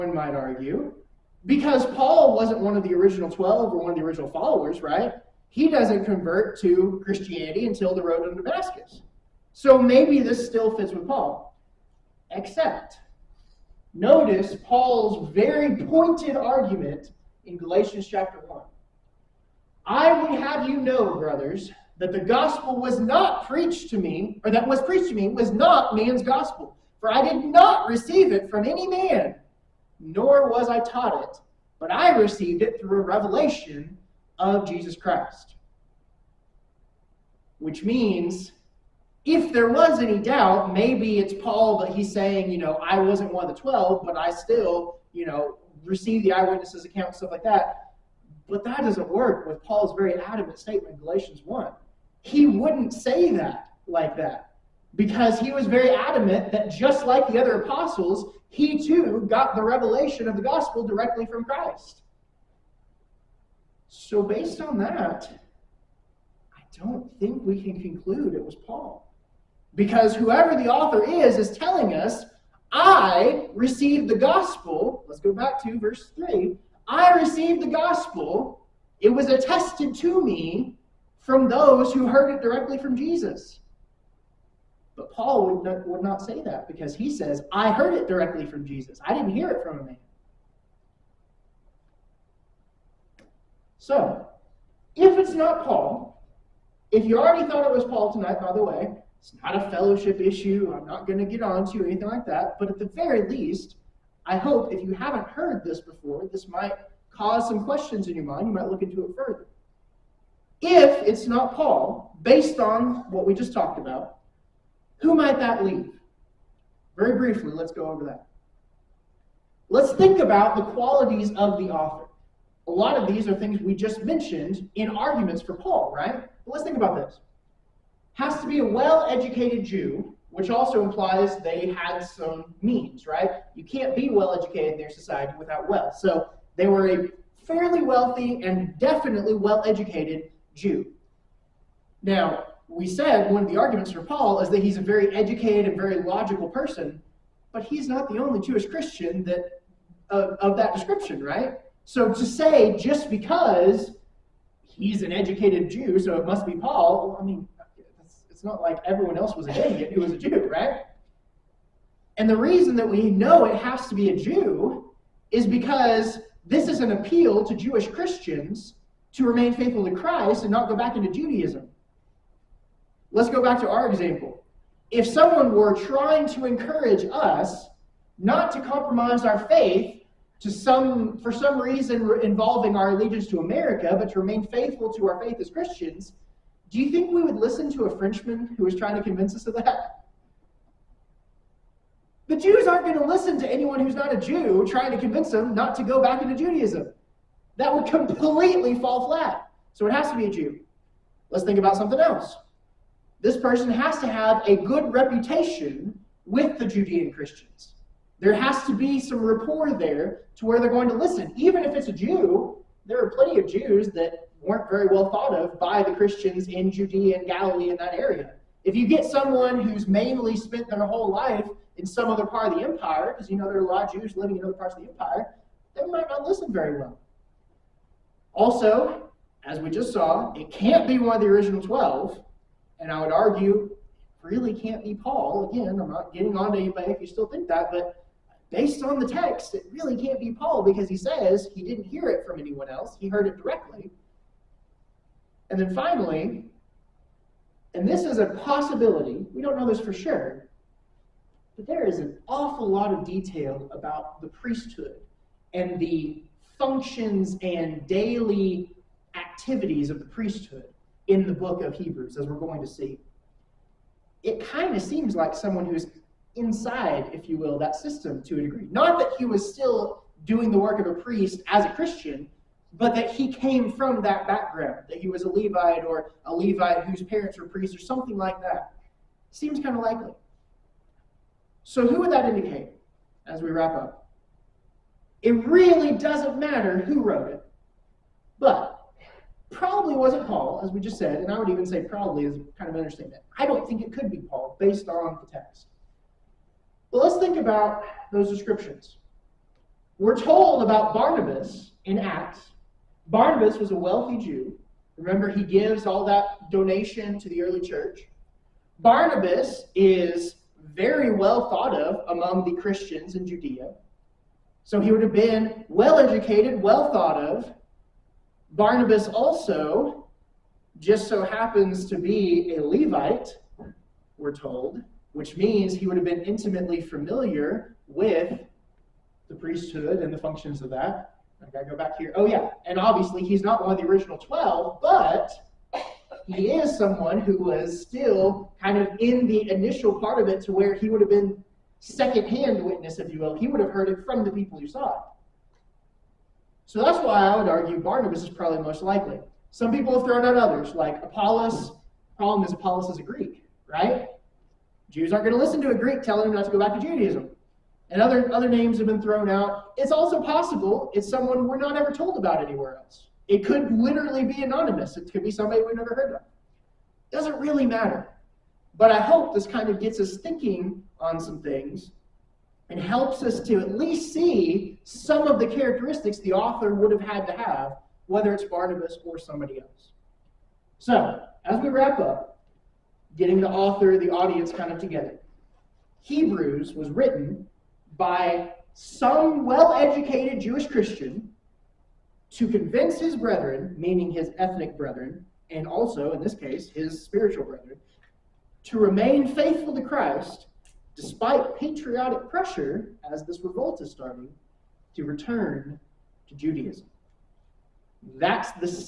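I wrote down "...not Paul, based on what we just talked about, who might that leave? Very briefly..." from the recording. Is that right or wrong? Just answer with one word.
right.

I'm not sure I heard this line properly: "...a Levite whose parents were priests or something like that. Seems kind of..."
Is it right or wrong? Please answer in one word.
right.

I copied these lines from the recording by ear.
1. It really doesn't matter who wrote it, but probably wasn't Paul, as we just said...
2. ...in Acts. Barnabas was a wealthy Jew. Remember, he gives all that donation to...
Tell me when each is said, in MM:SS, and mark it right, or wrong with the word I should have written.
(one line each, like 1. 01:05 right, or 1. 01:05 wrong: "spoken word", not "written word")
1. 04:45 right
2. 05:01 right.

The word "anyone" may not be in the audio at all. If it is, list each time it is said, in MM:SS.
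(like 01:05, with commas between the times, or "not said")
03:13, 04:02.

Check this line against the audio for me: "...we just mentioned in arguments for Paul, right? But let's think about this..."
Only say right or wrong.
right.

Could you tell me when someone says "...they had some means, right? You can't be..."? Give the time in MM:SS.
02:11.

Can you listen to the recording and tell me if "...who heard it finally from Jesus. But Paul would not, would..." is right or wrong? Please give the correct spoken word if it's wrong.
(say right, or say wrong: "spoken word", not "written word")
wrong: "directly", not "finally".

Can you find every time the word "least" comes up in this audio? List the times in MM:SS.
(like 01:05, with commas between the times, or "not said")
01:43, 06:13.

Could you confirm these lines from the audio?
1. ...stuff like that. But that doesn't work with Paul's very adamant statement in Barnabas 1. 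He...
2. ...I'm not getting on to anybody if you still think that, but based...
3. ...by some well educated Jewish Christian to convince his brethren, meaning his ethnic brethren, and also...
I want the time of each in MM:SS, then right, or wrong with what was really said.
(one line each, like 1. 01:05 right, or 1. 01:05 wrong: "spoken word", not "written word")
1. 00:47 wrong: "Galatians", not "Barnabas"
2. 03:55 right
3. 06:27 right.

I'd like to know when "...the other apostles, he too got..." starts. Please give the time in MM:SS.
00:57.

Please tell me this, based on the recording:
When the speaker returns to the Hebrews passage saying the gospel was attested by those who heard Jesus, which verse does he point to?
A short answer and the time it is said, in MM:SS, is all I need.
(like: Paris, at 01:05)
Verse 3, at 01:15.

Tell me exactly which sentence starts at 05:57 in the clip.
And other, other names have been thrown out.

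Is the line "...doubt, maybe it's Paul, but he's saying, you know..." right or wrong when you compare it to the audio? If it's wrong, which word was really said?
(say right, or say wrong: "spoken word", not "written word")
right.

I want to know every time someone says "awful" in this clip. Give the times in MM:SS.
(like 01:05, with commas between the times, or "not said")
04:12.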